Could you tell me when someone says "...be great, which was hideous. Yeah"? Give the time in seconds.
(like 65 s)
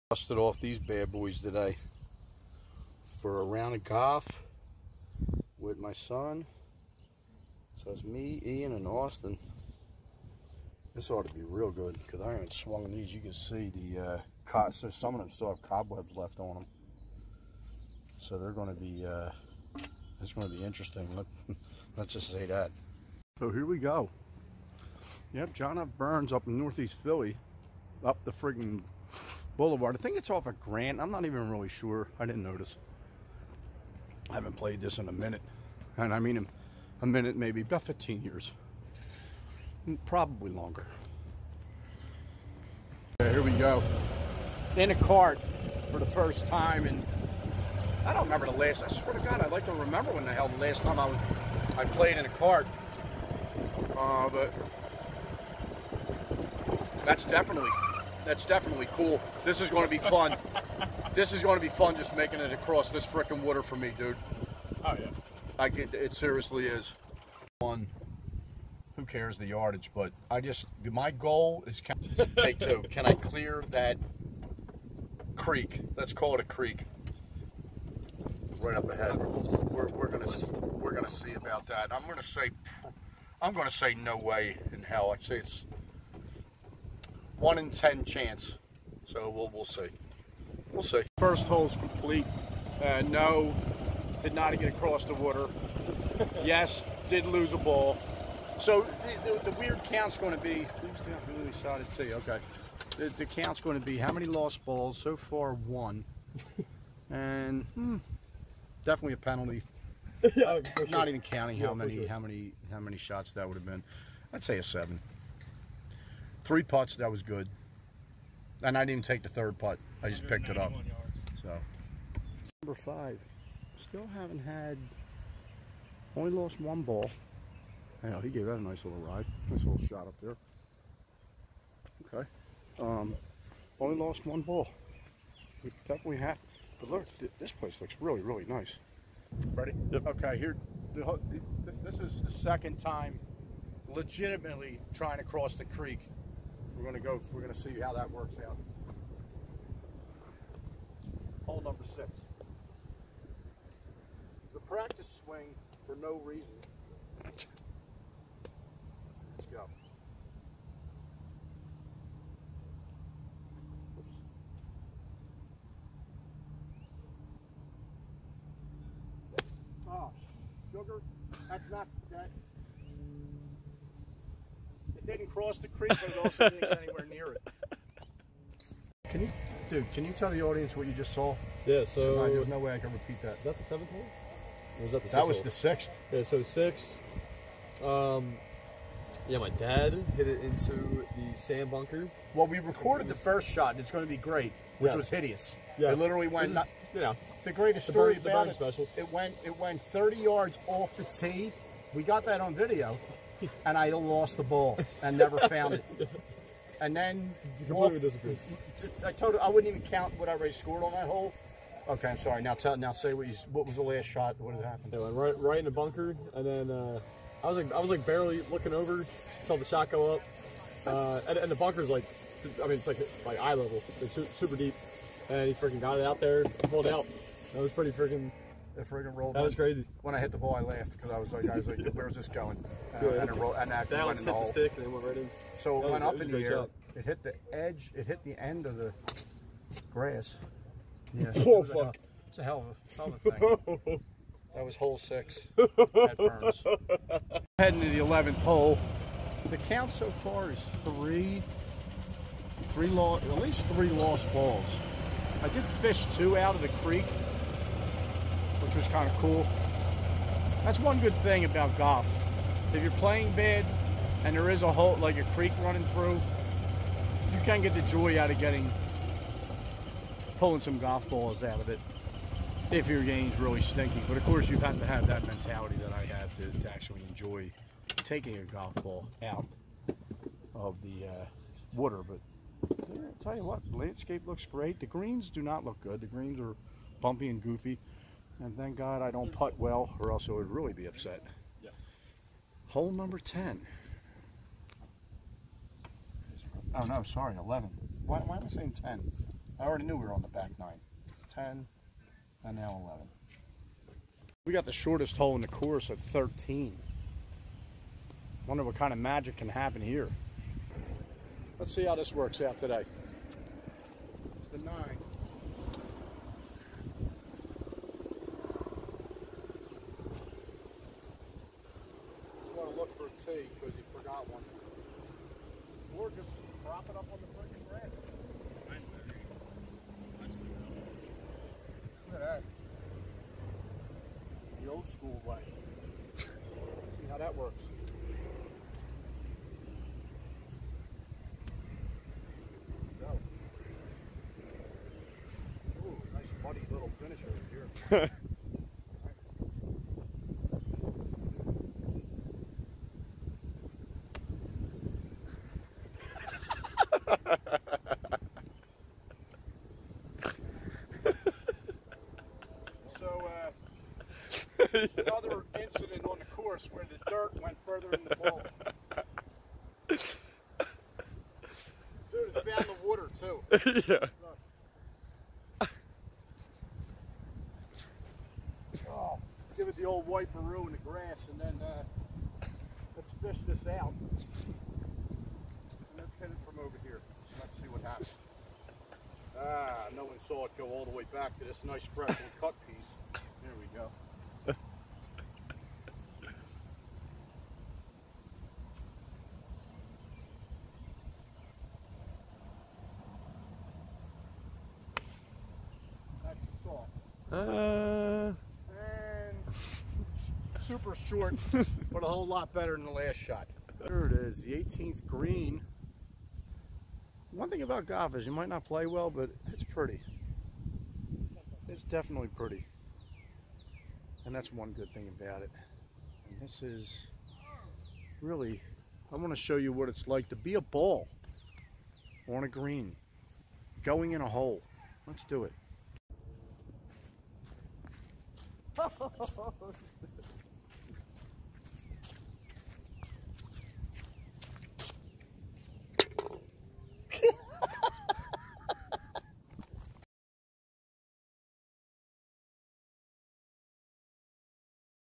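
194 s.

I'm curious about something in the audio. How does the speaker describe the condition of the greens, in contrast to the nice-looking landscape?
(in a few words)
bumpy and goofy.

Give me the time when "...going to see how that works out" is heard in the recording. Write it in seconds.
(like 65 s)
147 s.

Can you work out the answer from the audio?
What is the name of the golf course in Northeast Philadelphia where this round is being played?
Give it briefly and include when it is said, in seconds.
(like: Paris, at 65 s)
John F. Byrne's, at 25 s.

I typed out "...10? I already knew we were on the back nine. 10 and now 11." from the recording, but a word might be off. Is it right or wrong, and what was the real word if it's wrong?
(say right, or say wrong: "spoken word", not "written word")
right.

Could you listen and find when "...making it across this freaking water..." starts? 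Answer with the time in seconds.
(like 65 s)
62 s.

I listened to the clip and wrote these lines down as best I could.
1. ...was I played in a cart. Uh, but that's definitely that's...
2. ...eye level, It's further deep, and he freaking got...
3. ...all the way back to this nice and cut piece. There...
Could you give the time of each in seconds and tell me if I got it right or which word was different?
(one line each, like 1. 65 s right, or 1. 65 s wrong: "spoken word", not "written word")
1. 51 s right
2. 223 s wrong: "super", not "further"
3. 390 s right.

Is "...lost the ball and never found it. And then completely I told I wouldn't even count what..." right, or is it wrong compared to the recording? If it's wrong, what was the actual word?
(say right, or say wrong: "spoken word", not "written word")
right.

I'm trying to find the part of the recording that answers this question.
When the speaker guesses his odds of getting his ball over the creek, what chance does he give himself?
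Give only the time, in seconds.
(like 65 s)
87 s.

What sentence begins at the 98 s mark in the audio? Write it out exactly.
So the, the, the weird count's going to be, really side to see, okay.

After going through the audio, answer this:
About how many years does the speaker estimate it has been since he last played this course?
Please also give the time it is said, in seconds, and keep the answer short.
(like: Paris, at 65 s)
15, at 37 s.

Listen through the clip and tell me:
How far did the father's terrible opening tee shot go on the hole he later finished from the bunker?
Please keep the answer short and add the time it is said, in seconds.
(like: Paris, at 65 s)
30 yards, at 199 s.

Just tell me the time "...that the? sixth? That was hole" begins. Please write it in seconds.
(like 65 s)
184 s.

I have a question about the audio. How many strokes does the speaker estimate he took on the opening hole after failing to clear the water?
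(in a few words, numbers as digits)
7.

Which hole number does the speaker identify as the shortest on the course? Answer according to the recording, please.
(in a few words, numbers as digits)
13.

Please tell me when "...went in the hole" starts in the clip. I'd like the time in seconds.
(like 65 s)
234 s.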